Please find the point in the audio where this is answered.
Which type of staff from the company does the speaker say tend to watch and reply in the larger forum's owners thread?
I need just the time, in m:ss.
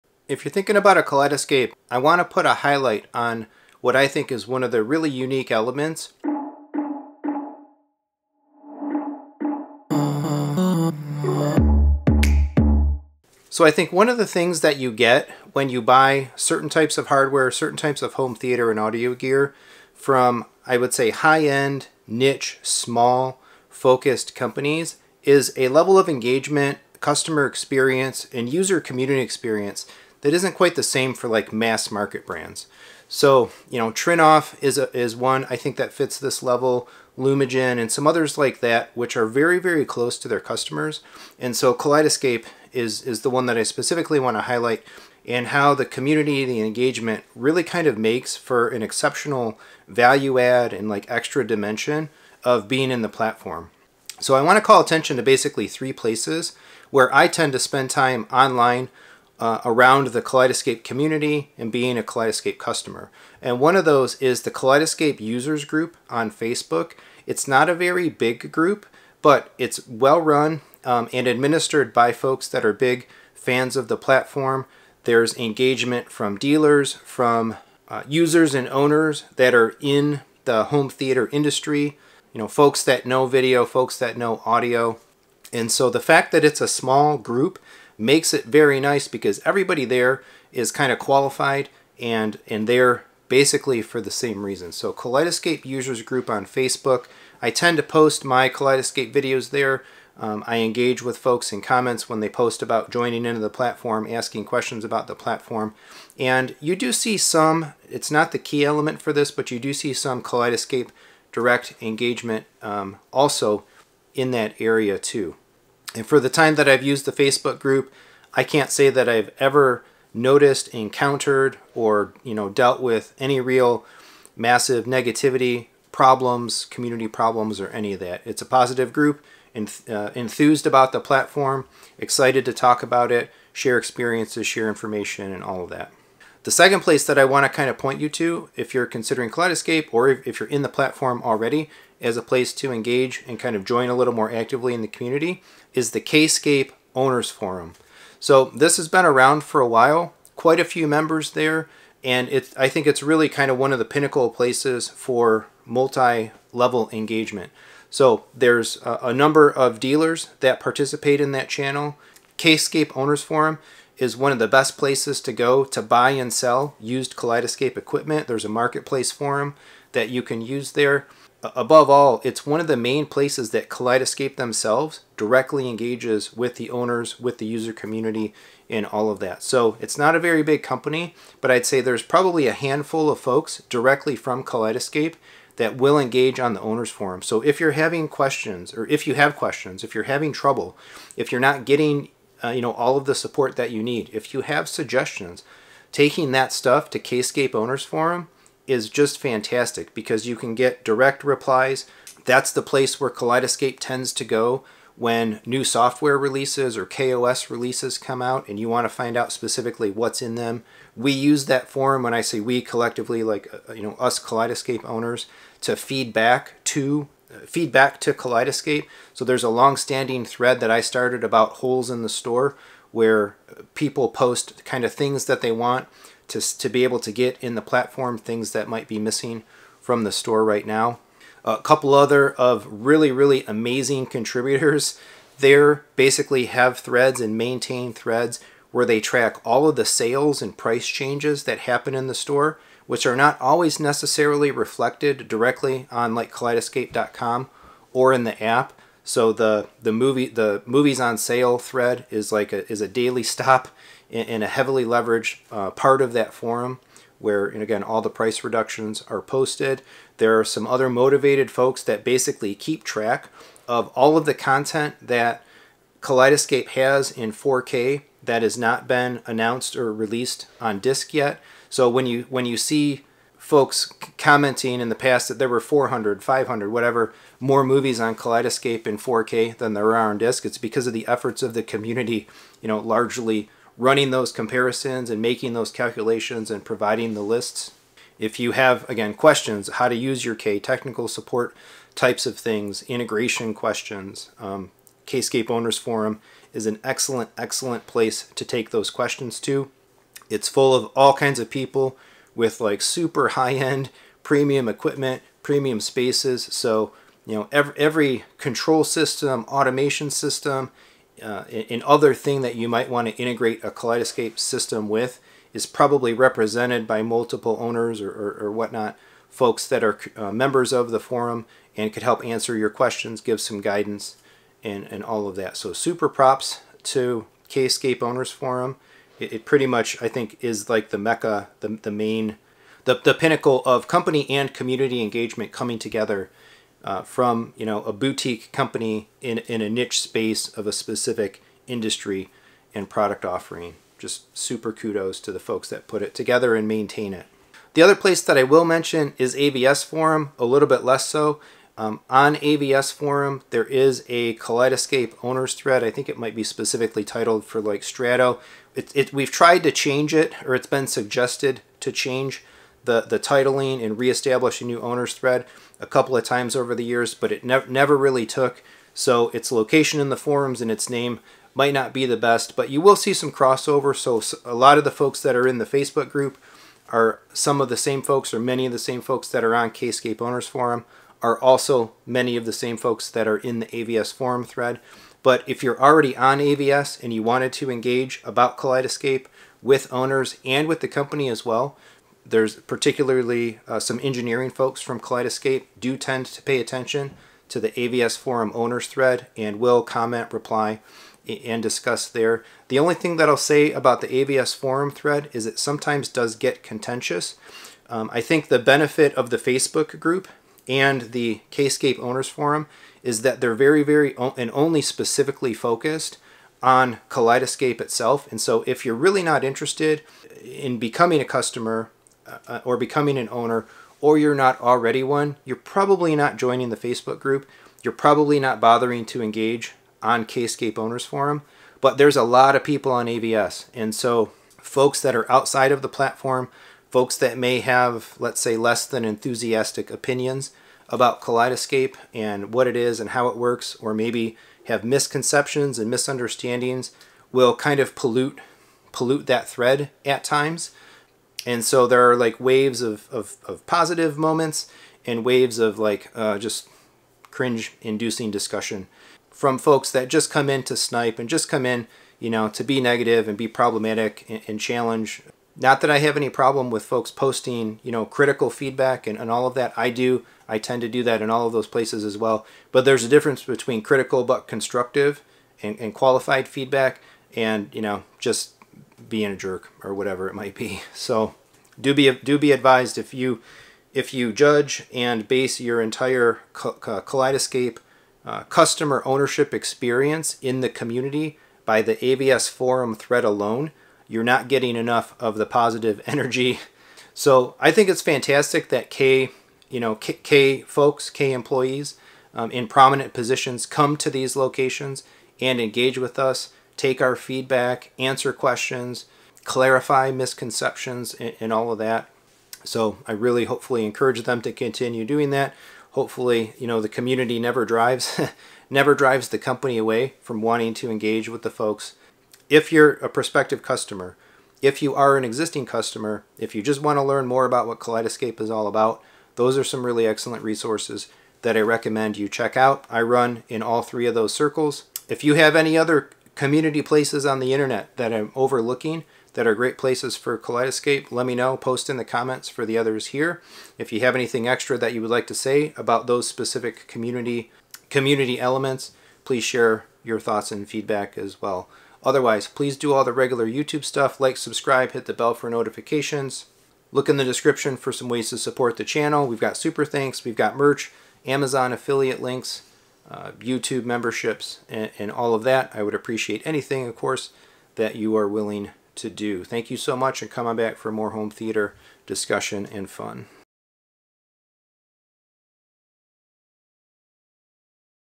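6:34.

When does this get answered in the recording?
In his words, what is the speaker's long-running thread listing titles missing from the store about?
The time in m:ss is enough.
3:41.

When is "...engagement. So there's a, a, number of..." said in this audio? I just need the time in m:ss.
2:36.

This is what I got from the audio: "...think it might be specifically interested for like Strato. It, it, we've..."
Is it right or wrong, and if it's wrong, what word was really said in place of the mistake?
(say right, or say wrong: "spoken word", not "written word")
wrong: "titled", not "interested".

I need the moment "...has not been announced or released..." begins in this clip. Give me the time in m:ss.
4:28.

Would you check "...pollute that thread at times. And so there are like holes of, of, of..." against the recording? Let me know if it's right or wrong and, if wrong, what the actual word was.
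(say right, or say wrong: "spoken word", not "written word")
wrong: "waves", not "holes".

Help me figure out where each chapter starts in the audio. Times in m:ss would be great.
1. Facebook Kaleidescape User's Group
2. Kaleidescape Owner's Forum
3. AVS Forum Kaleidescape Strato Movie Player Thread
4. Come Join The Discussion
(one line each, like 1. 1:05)
1. 1:03
2. 2:16
3. 5:47
4. 8:17.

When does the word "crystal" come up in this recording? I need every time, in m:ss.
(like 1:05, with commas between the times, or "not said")
not said.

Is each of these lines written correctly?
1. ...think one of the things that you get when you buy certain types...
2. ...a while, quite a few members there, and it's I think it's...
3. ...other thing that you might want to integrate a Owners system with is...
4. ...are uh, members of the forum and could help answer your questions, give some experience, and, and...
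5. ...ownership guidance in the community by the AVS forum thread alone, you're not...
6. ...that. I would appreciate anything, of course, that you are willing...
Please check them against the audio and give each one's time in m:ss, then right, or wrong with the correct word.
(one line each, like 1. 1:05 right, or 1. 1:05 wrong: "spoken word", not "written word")
1. 0:13 right
2. 2:29 right
3. 5:11 wrong: "Kaleidescape", not "Owners"
4. 5:19 wrong: "guidance", not "experience"
5. 8:09 wrong: "experience", not "guidance"
6. 9:25 right.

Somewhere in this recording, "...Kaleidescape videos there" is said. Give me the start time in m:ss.
1:38.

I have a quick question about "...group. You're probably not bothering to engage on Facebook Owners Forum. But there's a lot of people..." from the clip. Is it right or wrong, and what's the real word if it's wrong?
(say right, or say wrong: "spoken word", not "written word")
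wrong: "Kscape", not "Facebook".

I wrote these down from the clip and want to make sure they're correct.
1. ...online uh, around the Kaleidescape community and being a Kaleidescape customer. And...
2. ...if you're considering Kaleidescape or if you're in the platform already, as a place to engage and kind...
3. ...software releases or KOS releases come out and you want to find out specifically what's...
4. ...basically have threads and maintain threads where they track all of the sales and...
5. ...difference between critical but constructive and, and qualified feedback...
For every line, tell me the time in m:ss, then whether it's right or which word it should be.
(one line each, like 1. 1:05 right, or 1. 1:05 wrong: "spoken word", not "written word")
1. 0:58 right
2. 2:18 right
3. 3:25 right
4. 3:55 right
5. 7:53 right.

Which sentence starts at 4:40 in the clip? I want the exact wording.
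It's because of the efforts of the community, you know, largely running those comparisons and making those calculations and providing the lists.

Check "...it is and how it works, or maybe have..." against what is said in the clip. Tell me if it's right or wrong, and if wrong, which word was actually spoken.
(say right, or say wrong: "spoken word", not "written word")
right.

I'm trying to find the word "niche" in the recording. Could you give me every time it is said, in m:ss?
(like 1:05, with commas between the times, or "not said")
0:22, 5:39.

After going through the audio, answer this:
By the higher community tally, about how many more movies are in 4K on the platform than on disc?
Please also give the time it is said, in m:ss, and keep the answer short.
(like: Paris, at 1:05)
500, at 4:36.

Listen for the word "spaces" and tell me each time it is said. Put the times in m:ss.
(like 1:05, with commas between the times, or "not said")
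5:05, 5:40.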